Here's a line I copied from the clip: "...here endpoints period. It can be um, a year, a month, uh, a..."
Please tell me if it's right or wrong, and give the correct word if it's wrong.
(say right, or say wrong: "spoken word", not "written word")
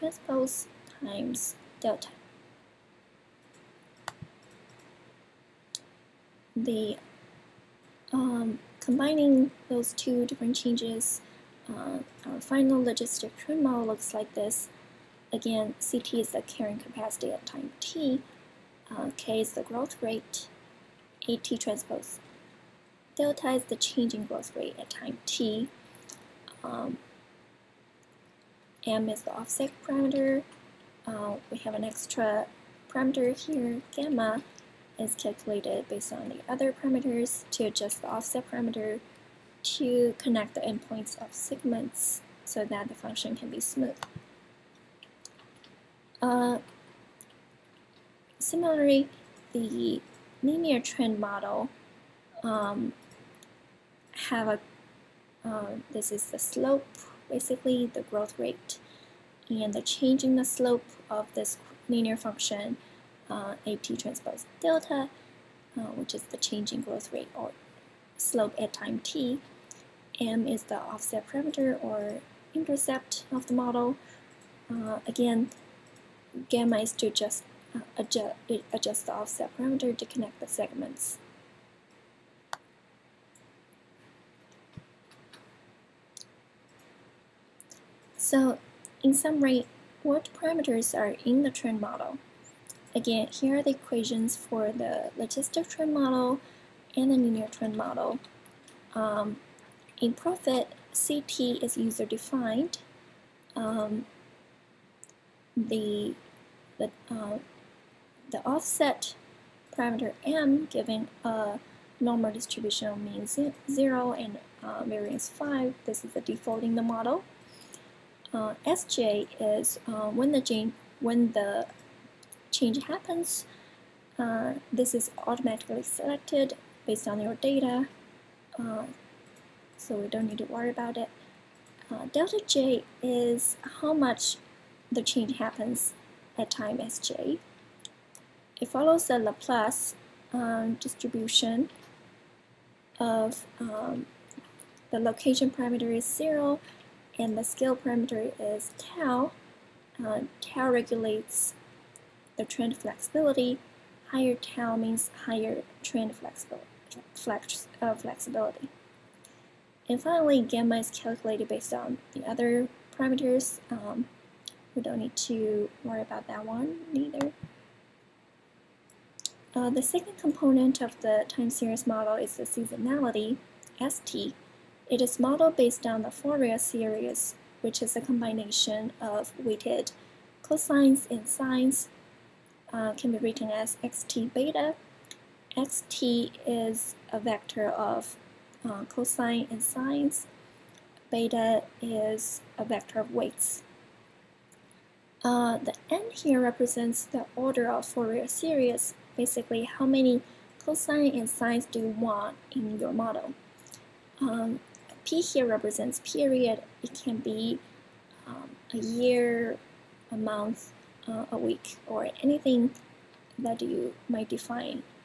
wrong: "represents", not "endpoints".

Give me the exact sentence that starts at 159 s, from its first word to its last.
And finally, gamma is calculated based on the other parameters.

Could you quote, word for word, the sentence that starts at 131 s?
Uh, delta J is how much the change happens at time Sj.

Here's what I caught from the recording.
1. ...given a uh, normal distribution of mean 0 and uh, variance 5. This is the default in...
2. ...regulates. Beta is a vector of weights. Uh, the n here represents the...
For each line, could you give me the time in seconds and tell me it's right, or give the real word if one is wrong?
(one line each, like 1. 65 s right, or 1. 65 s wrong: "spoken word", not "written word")
1. 110 s right
2. 189 s wrong: "sines", not "regulates".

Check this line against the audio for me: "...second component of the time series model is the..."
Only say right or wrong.
right.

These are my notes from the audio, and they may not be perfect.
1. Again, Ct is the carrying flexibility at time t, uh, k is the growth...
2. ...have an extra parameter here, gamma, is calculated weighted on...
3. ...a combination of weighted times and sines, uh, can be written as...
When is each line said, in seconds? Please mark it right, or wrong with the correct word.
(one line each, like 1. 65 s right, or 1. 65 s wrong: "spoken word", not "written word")
1. 15 s wrong: "capacity", not "flexibility"
2. 31 s wrong: "based", not "weighted"
3. 177 s wrong: "cosines", not "times".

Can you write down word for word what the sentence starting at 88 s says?
So in summary, what parameters are in the trend model?